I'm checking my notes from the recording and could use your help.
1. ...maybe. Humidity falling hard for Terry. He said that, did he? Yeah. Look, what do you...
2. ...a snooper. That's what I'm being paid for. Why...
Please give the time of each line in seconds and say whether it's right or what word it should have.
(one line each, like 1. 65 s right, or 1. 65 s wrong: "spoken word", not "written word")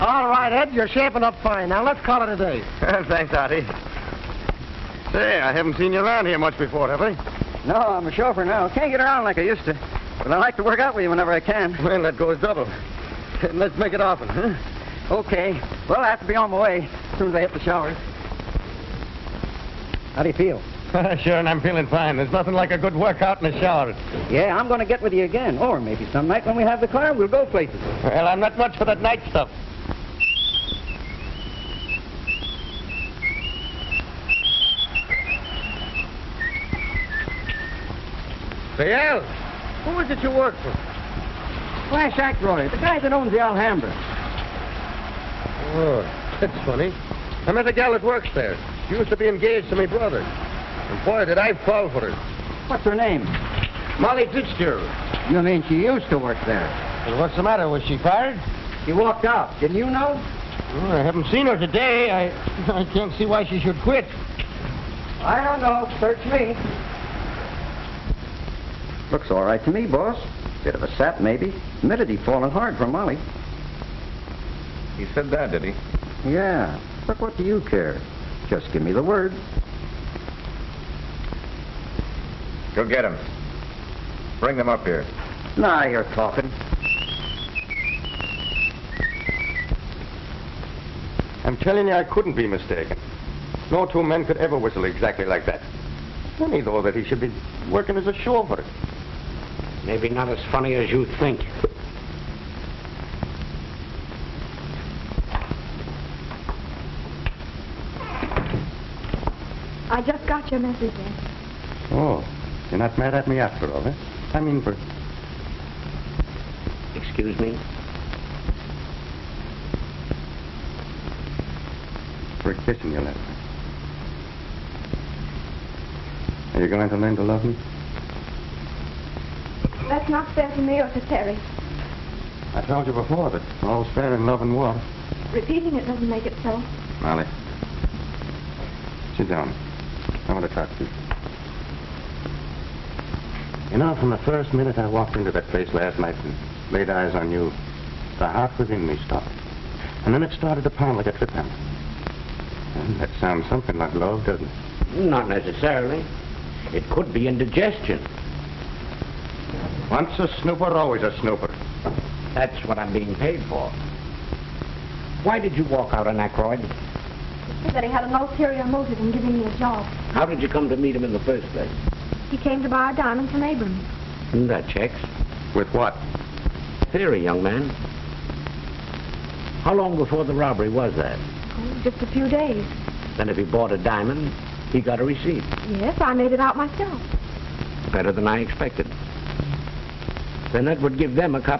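1. 71 s wrong: "Molly", not "Terry"
2. 161 s right.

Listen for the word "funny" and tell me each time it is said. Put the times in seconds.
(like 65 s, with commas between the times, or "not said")
46 s, 96 s, 100 s.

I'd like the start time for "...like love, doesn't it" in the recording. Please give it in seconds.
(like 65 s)
153 s.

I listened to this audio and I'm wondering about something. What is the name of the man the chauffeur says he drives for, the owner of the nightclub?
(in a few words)
Flash Ackroyd.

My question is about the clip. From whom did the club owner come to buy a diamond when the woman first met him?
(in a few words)
Abrams.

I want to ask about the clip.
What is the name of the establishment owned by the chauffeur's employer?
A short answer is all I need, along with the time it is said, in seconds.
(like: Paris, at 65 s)
the Alhambra, at 43 s.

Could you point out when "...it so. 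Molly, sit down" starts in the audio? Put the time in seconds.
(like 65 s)
136 s.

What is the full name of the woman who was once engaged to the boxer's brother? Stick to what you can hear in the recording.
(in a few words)
Molly Fitzgerald.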